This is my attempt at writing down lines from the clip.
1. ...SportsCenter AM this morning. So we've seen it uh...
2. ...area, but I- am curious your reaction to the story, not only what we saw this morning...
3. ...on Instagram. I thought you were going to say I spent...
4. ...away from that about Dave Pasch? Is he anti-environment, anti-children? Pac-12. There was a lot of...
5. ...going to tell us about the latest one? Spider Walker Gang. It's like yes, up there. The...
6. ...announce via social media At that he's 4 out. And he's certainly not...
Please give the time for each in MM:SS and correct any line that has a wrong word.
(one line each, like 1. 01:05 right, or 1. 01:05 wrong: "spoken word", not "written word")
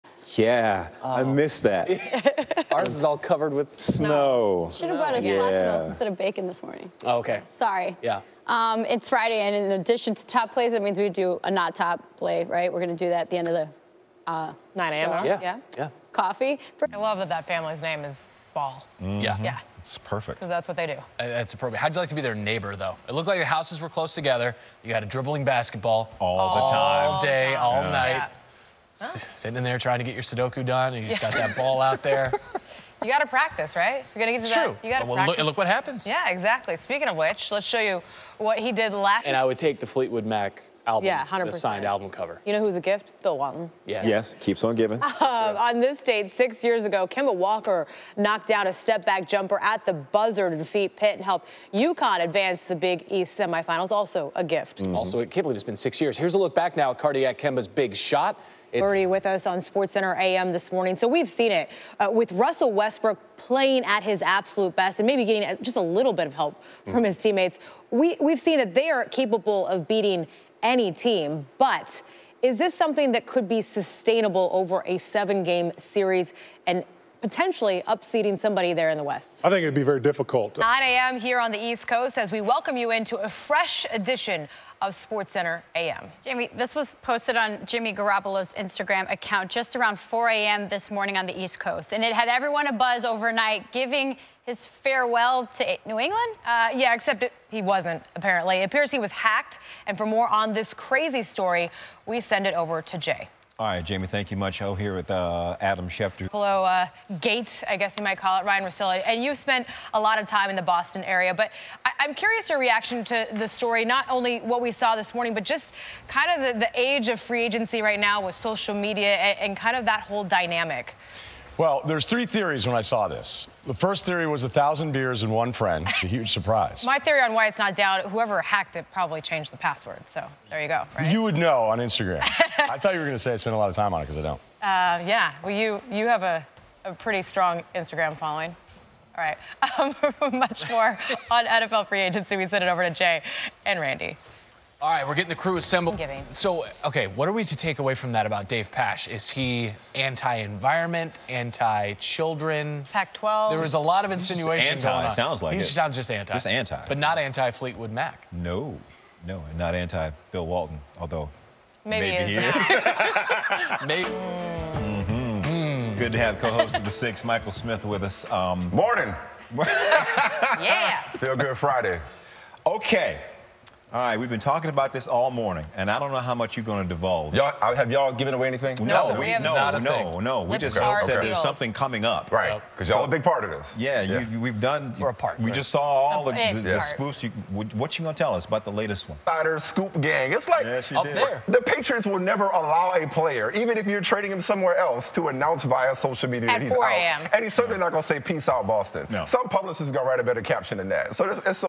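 1. 00:59 right
2. 01:51 right
3. 02:11 right
4. 02:27 right
5. 03:08 wrong: "Scoop", not "Walker"
6. 03:15 right.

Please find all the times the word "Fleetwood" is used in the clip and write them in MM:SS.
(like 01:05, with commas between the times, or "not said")
00:39, 02:37.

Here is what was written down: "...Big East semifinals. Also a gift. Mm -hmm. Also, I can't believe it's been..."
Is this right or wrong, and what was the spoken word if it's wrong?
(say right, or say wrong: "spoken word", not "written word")
right.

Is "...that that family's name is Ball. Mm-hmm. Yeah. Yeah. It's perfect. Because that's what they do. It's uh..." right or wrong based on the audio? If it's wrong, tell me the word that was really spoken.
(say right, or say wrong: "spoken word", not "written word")
right.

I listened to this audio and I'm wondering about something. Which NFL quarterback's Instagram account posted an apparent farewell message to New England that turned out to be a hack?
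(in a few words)
Jimmy Garoppolo.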